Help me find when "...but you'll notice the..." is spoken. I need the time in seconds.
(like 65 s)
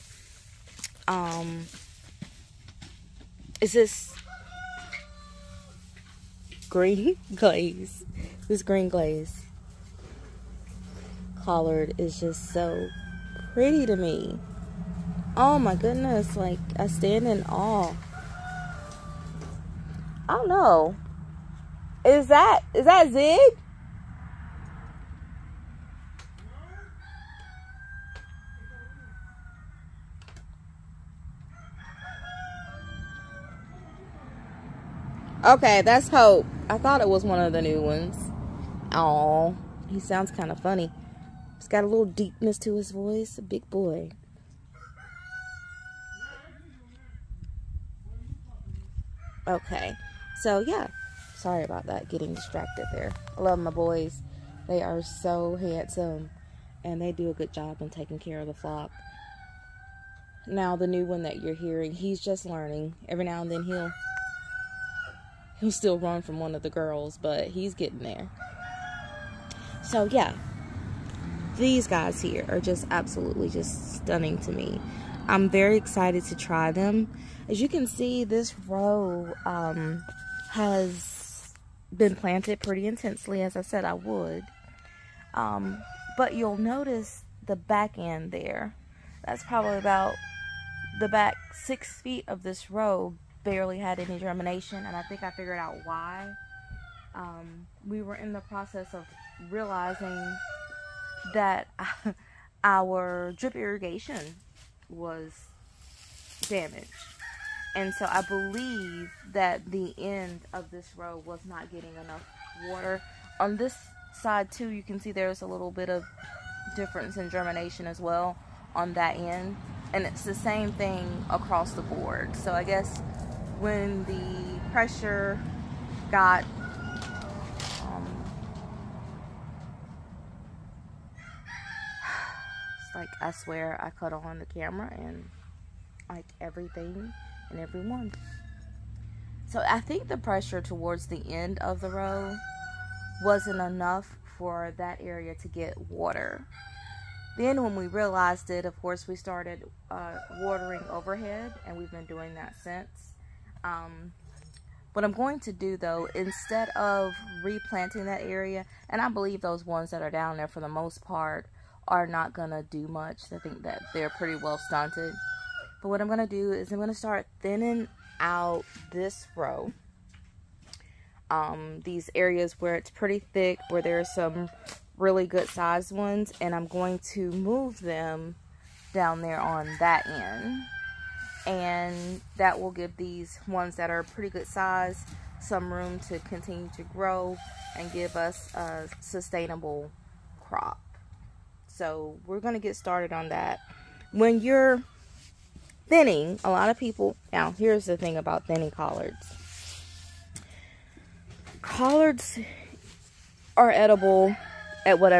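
86 s.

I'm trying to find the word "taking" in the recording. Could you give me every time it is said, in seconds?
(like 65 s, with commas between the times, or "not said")
57 s.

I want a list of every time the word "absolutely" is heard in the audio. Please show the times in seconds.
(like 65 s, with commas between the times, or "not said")
72 s.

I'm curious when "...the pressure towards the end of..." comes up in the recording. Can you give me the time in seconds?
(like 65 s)
140 s.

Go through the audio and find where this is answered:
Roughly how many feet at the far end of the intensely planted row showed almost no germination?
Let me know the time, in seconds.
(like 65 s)
91 s.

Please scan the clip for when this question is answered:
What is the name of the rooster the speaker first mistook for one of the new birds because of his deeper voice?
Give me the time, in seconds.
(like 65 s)
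36 s.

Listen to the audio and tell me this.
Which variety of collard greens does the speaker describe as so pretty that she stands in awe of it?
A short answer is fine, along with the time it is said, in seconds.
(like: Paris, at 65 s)
Green glaze, at 8 s.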